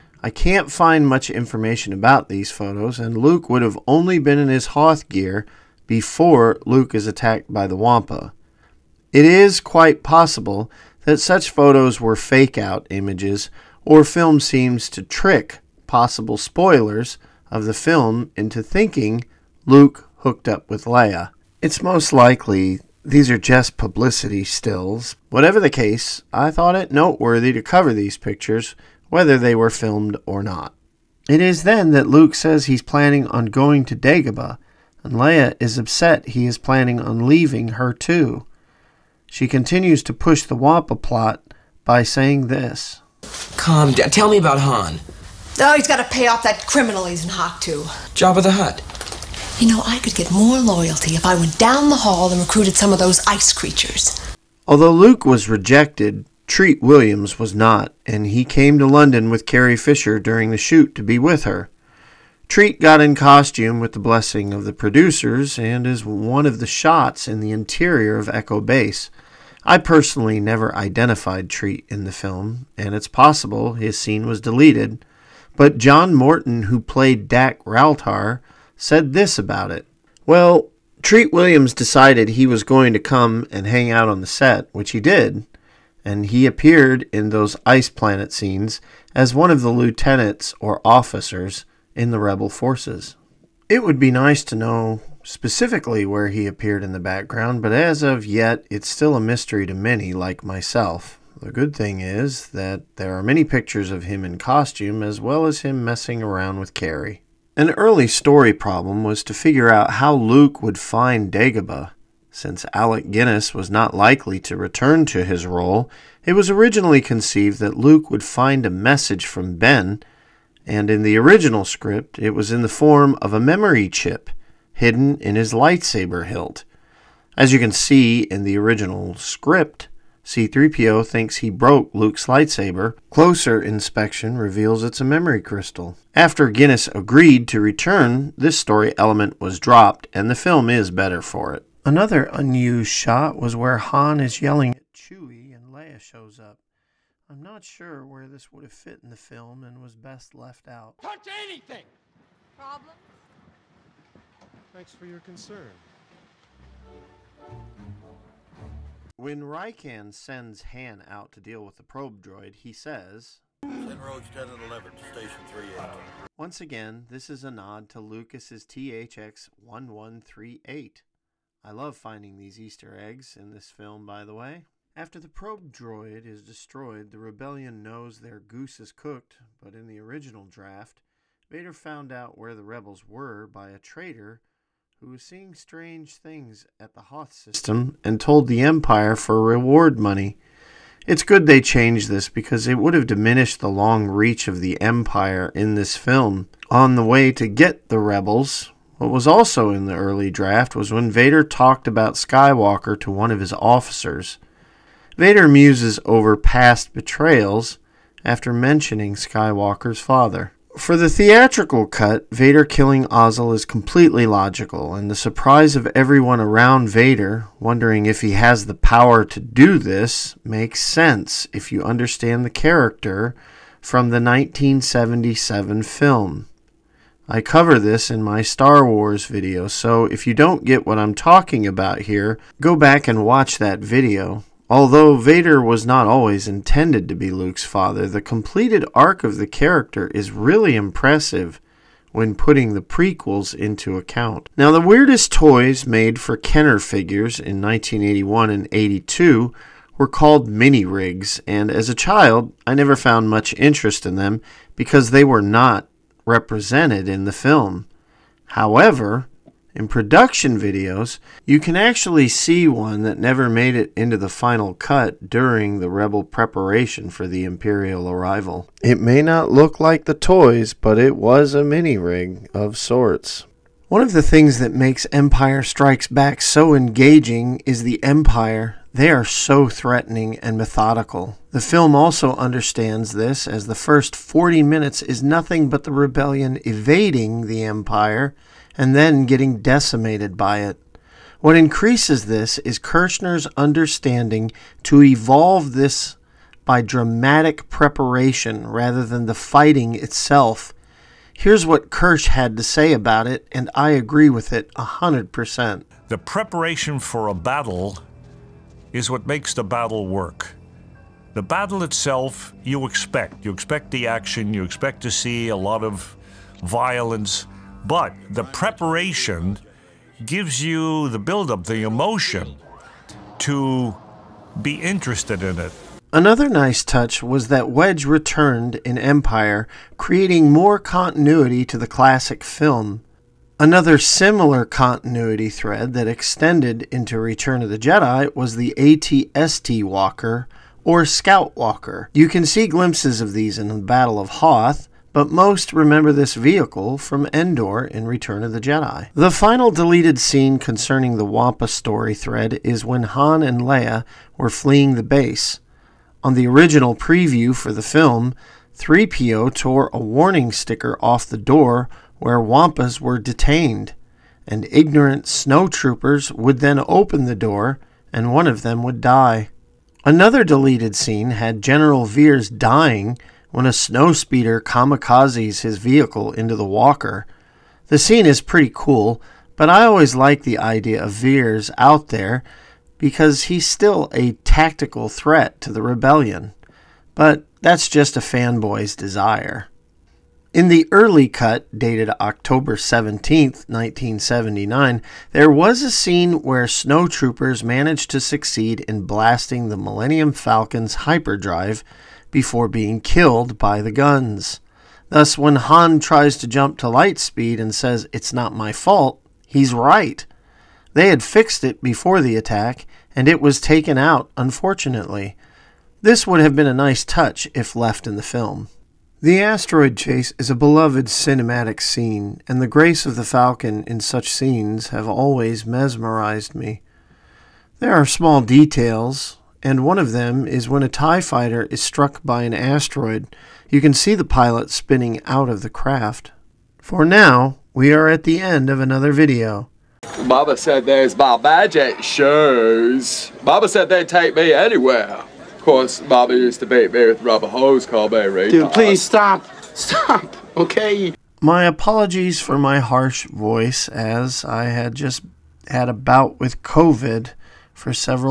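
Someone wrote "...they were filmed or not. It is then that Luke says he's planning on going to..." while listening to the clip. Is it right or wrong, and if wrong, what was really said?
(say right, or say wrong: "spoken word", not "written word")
right.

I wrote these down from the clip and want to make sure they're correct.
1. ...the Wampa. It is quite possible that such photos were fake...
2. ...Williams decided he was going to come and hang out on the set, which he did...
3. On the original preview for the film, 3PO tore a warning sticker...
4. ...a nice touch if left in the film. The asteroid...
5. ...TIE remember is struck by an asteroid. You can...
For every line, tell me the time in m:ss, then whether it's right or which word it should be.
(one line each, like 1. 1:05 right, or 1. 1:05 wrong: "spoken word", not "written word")
1. 0:07 right
2. 1:21 right
3. 5:56 right
4. 6:56 right
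5. 7:10 wrong: "fighter", not "remember".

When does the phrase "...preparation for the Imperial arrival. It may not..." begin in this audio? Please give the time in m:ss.
4:26.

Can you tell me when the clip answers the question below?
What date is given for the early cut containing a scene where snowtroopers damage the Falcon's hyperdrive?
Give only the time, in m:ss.
6:32.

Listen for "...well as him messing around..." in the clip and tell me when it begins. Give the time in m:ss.
1:45.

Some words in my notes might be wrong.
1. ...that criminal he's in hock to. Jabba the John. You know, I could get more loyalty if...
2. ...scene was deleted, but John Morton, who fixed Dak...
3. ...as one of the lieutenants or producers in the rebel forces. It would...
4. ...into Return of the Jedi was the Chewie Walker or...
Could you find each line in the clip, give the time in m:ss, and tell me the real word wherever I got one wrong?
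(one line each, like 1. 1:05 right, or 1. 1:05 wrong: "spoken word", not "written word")
1. 0:46 wrong: "Hutt", not "John"
2. 1:13 wrong: "played", not "fixed"
3. 1:29 wrong: "officers", not "producers"
4. 5:36 wrong: "ATST", not "Chewie".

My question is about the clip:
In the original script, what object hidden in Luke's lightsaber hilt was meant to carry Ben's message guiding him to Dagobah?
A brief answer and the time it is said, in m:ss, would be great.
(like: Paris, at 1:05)
memory chip, at 2:03.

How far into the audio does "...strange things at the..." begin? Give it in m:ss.
3:05.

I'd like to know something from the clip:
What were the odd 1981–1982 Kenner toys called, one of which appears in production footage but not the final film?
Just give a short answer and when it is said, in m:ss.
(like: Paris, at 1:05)
mini rigs, at 4:10.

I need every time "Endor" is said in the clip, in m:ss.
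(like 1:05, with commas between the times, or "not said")
5:47.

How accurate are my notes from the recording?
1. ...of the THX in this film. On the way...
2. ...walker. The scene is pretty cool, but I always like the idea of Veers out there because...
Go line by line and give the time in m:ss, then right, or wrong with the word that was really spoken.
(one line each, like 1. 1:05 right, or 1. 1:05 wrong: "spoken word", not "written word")
1. 3:14 wrong: "Empire", not "THX"
2. 6:16 right.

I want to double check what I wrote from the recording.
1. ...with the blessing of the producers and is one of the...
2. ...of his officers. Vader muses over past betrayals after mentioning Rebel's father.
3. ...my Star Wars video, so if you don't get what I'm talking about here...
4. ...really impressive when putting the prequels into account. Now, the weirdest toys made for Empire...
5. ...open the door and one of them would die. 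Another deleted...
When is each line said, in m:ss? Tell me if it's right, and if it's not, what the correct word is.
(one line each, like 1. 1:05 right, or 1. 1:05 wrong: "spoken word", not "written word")
1. 1:03 right
2. 3:23 wrong: "Skywalker", not "Rebel"
3. 3:48 right
4. 4:00 wrong: "Kenner", not "Empire"
5. 6:06 right.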